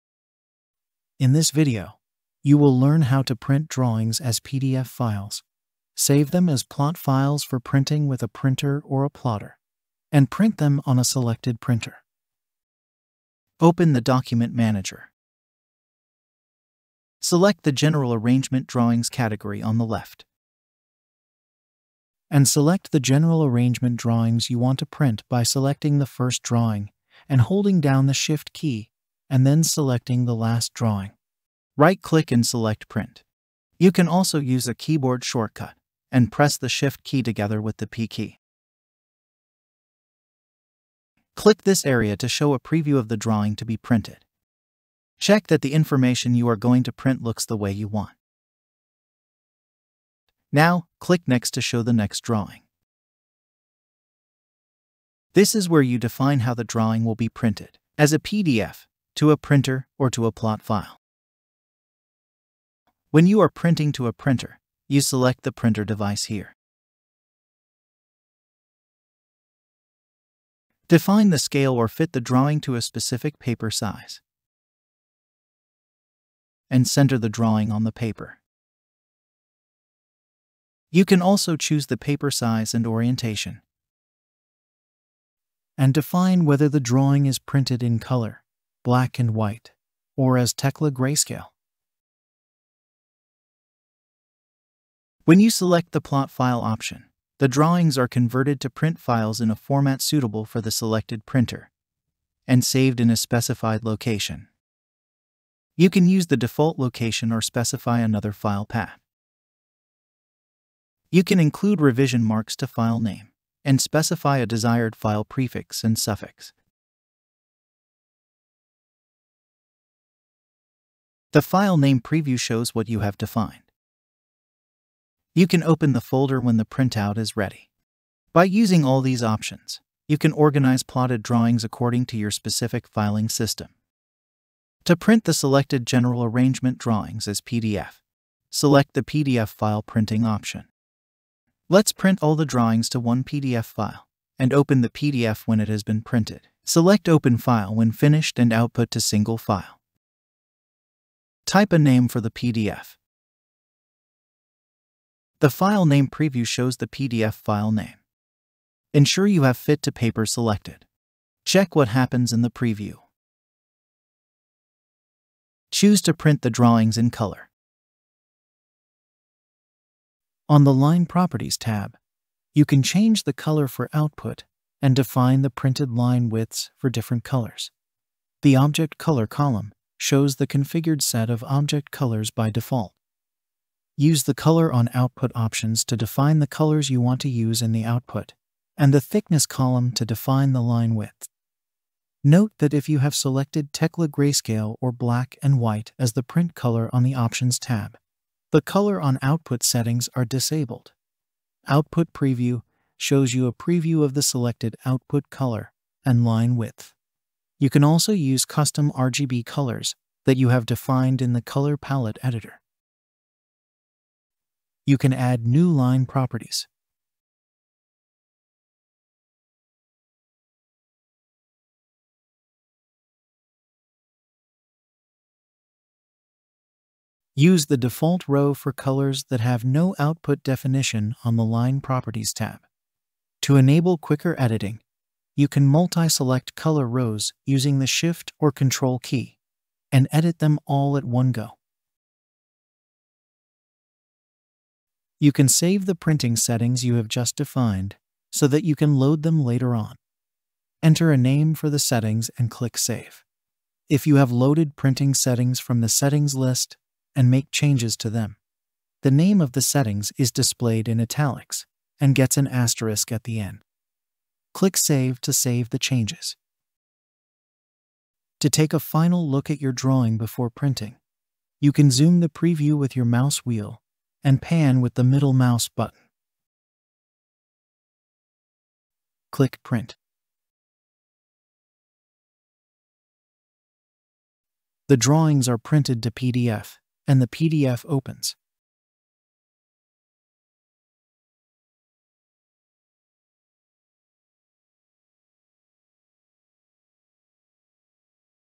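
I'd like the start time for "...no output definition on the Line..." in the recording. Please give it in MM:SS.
03:49.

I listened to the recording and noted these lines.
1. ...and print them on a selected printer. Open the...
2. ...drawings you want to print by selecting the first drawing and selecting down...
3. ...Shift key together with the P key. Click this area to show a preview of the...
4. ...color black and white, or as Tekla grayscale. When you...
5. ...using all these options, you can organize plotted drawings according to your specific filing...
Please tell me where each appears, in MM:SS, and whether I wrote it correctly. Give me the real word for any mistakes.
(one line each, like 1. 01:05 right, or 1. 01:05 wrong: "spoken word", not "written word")
1. 00:10 right
2. 00:23 wrong: "holding", not "selecting"
3. 00:36 right
4. 01:27 right
5. 02:08 right.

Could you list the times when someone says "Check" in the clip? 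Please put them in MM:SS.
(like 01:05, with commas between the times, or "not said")
00:45, 02:41.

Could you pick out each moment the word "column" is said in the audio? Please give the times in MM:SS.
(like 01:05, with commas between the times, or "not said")
02:59, 03:09.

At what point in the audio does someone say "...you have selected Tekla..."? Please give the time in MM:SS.
03:12.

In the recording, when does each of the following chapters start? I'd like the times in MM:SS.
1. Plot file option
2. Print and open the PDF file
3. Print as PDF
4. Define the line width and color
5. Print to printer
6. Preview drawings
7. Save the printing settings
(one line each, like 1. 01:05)
1. 01:35
2. 04:39
3. 02:15
4. 02:50
5. 01:03
6. 00:43
7. 04:05.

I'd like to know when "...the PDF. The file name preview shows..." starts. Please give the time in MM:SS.
02:32.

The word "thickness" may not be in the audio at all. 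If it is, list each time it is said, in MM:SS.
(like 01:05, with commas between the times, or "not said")
03:08.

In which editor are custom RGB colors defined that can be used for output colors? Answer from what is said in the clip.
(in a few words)
Color Palette editor.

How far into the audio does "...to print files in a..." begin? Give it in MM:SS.
01:38.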